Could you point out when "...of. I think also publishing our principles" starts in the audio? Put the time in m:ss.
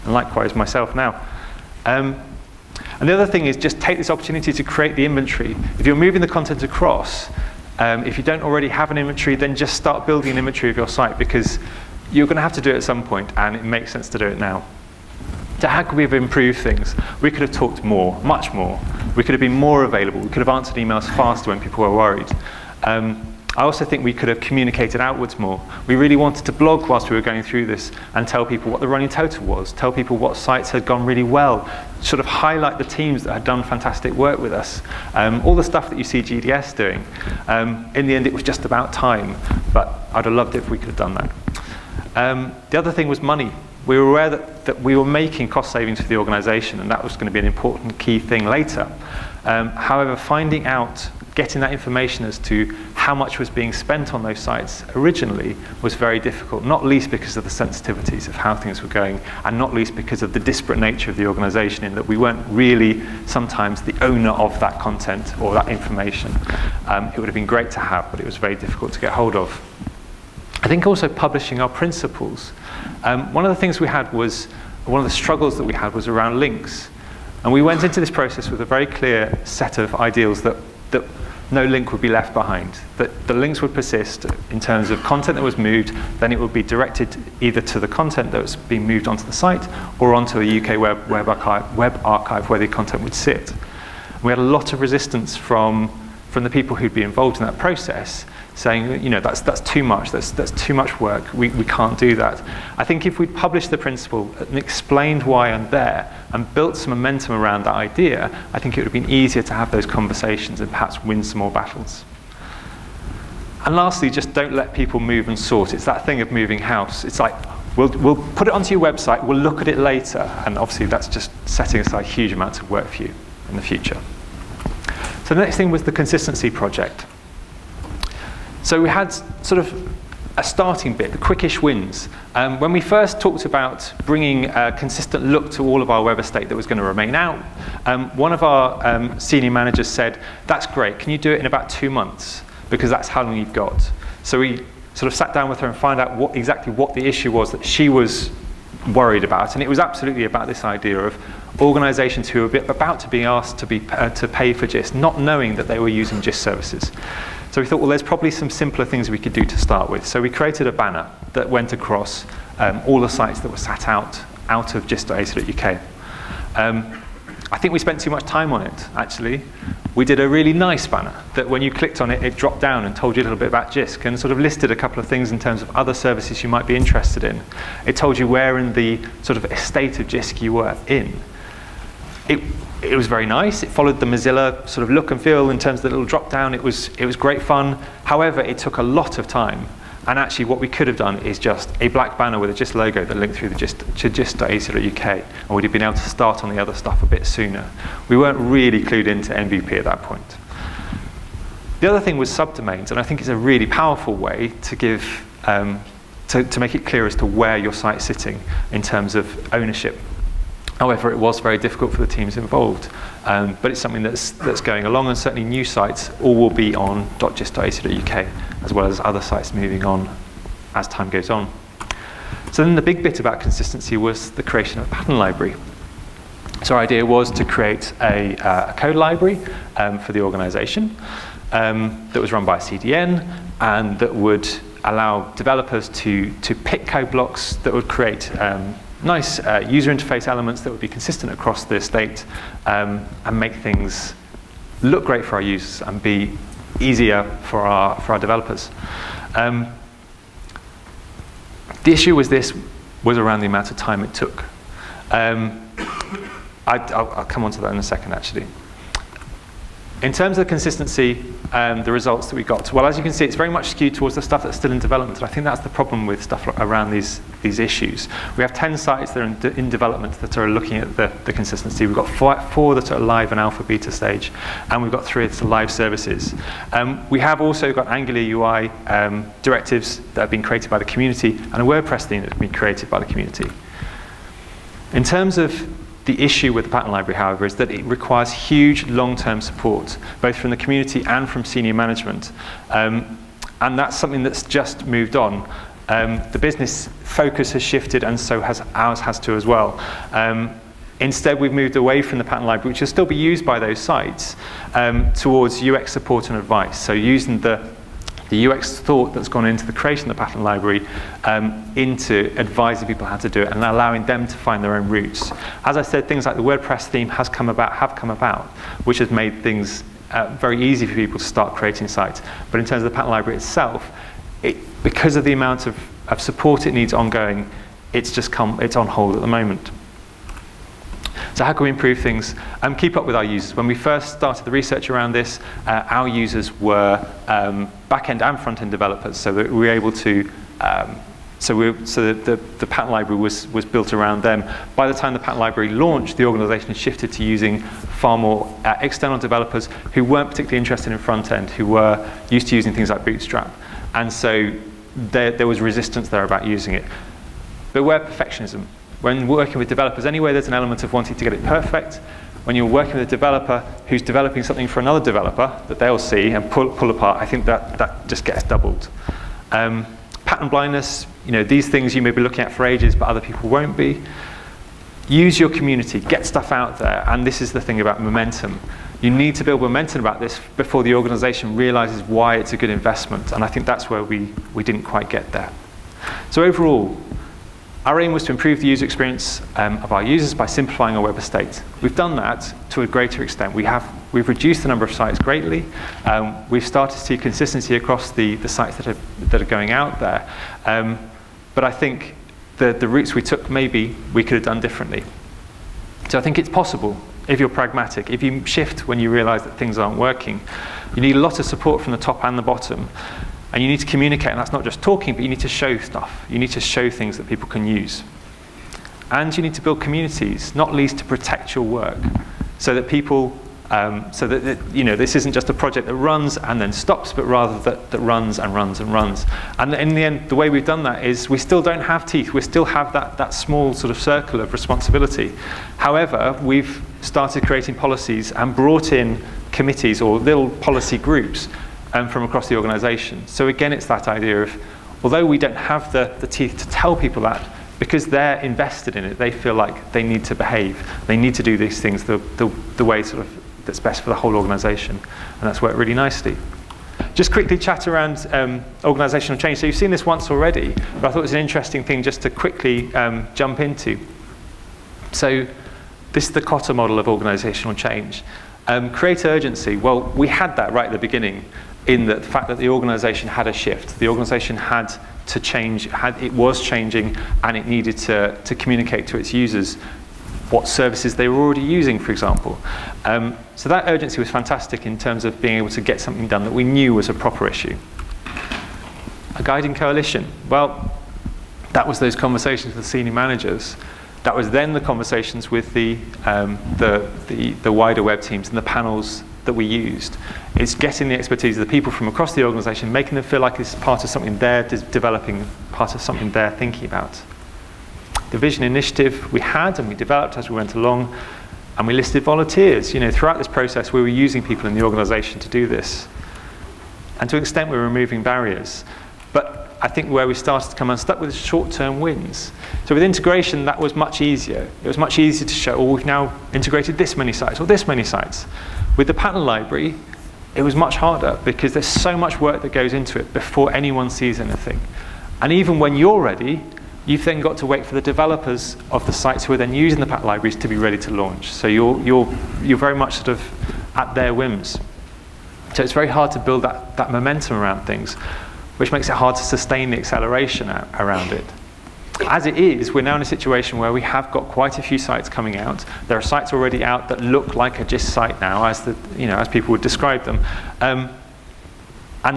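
1:09.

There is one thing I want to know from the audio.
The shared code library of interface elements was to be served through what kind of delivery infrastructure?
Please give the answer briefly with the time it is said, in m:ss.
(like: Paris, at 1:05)
A CDN, at 3:52.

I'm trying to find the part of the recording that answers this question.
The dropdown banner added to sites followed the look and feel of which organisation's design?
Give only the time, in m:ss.
3:04.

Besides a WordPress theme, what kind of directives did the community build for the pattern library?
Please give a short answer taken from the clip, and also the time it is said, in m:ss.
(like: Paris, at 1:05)
Angular UI, at 4:37.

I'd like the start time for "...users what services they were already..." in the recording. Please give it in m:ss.
7:59.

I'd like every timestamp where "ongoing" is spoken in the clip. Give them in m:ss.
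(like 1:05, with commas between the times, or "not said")
5:26.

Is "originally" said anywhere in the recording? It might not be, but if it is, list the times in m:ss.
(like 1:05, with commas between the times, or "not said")
0:54.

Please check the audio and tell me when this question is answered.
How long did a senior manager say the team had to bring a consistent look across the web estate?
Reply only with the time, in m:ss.
2:21.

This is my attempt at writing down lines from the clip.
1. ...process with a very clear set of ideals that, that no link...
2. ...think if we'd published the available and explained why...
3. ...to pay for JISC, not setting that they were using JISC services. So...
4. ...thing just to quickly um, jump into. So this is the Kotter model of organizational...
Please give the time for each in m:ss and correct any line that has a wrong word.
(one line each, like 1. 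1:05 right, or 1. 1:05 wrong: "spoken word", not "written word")
1. 1:18 right
2. 1:42 wrong: "principle", not "available"
3. 2:34 wrong: "knowing", not "setting"
4. 7:41 right.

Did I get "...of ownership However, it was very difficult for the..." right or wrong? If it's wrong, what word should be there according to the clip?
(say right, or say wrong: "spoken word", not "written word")
right.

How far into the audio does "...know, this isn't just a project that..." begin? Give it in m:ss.
7:04.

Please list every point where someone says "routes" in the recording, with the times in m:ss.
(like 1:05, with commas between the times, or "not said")
5:14, 6:42.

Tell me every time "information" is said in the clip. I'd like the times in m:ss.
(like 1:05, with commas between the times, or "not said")
0:51, 1:05.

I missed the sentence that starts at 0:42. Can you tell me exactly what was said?
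Um, the other thing was money.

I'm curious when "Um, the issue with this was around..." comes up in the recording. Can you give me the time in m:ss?
4:09.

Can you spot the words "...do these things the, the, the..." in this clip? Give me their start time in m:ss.
7:31.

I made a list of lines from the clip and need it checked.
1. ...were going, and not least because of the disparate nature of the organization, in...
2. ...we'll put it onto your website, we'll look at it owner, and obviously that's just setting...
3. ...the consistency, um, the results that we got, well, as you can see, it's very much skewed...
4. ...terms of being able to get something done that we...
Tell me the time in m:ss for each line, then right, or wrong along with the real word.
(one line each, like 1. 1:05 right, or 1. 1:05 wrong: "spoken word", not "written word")
1. 0:58 right
2. 1:57 wrong: "later", not "owner"
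3. 4:20 right
4. 8:04 right.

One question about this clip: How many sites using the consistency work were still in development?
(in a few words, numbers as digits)
10.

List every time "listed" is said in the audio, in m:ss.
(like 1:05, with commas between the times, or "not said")
2:54, 8:31.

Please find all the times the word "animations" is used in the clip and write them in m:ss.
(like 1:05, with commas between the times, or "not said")
not said.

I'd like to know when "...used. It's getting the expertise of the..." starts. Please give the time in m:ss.
8:19.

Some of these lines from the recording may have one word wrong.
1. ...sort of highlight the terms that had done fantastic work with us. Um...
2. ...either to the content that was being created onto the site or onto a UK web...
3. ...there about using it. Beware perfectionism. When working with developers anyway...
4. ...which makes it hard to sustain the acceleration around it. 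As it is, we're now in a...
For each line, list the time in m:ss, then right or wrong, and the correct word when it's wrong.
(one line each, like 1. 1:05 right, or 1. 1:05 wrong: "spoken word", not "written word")
1. 0:32 wrong: "teams", not "terms"
2. 1:27 wrong: "moved", not "created"
3. 5:56 right
4. 9:08 right.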